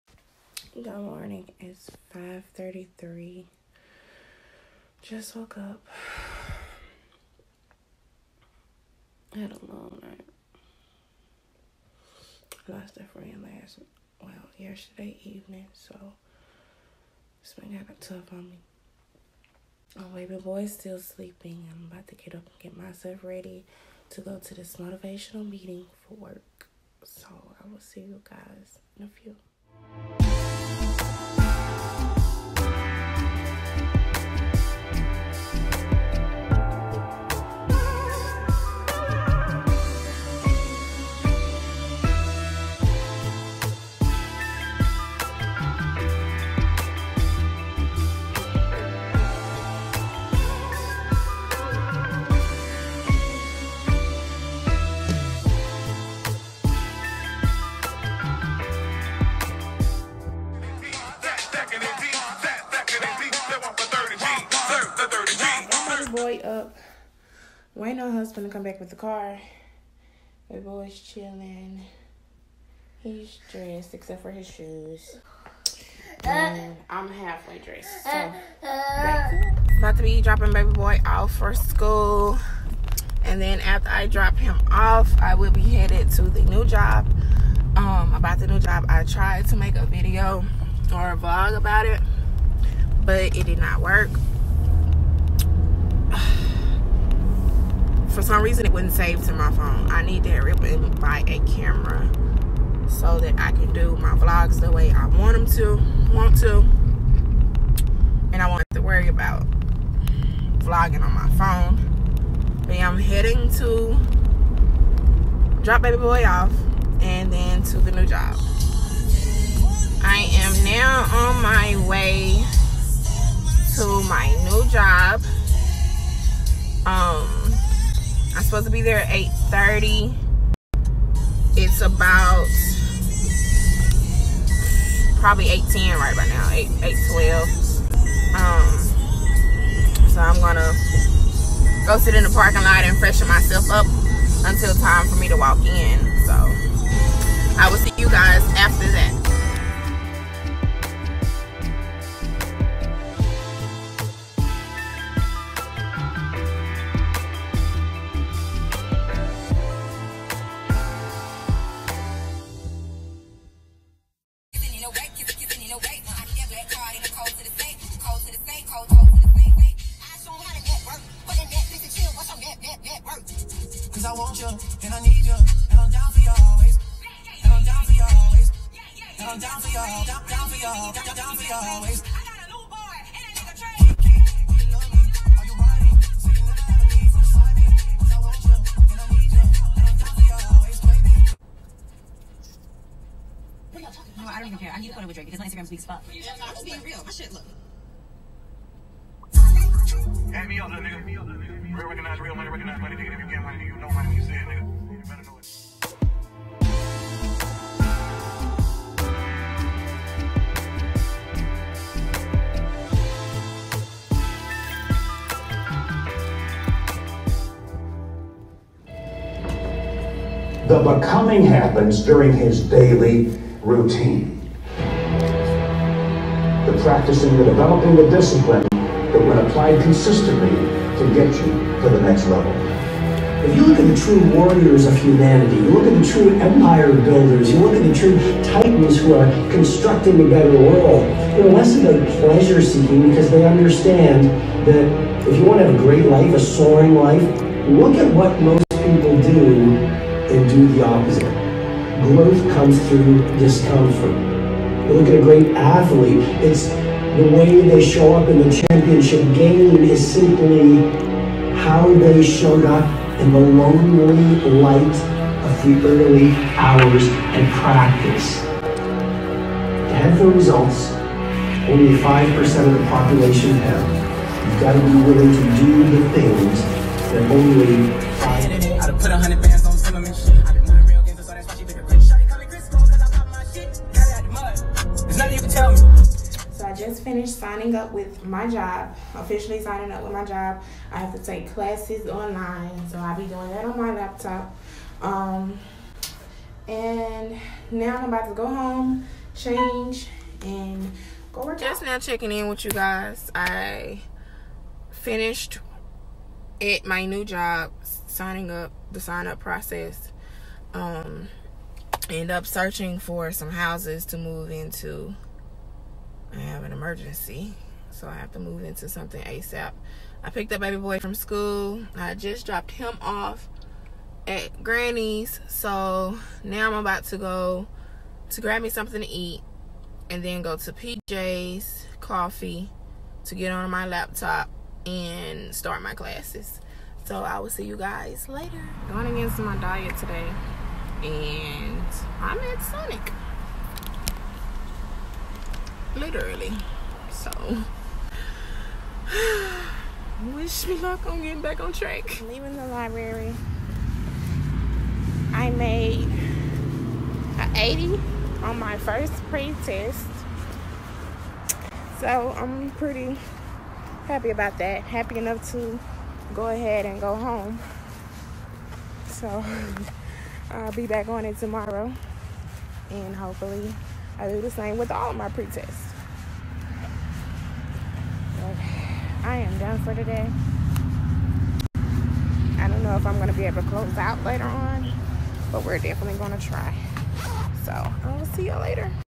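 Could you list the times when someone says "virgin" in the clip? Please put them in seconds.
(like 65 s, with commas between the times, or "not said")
not said.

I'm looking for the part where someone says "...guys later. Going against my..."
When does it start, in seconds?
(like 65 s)
337 s.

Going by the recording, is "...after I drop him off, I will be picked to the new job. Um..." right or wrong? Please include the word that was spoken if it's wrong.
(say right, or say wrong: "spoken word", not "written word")
wrong: "headed", not "picked".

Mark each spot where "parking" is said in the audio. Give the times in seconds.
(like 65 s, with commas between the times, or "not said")
142 s.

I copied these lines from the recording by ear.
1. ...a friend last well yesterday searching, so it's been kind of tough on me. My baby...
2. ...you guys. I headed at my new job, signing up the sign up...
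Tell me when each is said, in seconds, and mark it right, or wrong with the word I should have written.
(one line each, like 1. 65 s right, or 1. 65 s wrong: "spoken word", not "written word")
1. 12 s wrong: "evening", not "searching"
2. 302 s wrong: "finished", not "headed".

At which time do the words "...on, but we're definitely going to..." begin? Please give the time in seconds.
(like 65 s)
384 s.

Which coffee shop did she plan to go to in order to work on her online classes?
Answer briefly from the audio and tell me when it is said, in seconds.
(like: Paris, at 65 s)
PJ's Coffee, at 330 s.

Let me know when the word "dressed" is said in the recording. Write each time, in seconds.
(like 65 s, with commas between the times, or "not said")
73 s, 77 s.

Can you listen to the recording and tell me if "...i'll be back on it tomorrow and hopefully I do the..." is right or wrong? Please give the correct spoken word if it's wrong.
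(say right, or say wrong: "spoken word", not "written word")
right.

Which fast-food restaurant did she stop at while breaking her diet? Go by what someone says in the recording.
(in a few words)
Sonic.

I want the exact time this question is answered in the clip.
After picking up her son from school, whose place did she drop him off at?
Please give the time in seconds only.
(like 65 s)
324 s.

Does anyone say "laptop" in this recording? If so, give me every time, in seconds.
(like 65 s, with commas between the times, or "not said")
293 s, 333 s.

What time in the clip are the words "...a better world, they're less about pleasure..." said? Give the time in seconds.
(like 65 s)
240 s.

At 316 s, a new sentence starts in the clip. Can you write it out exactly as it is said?
I have an emergency, so I have to move into something ASAP.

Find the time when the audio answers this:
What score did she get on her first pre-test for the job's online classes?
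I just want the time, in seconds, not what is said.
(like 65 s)
357 s.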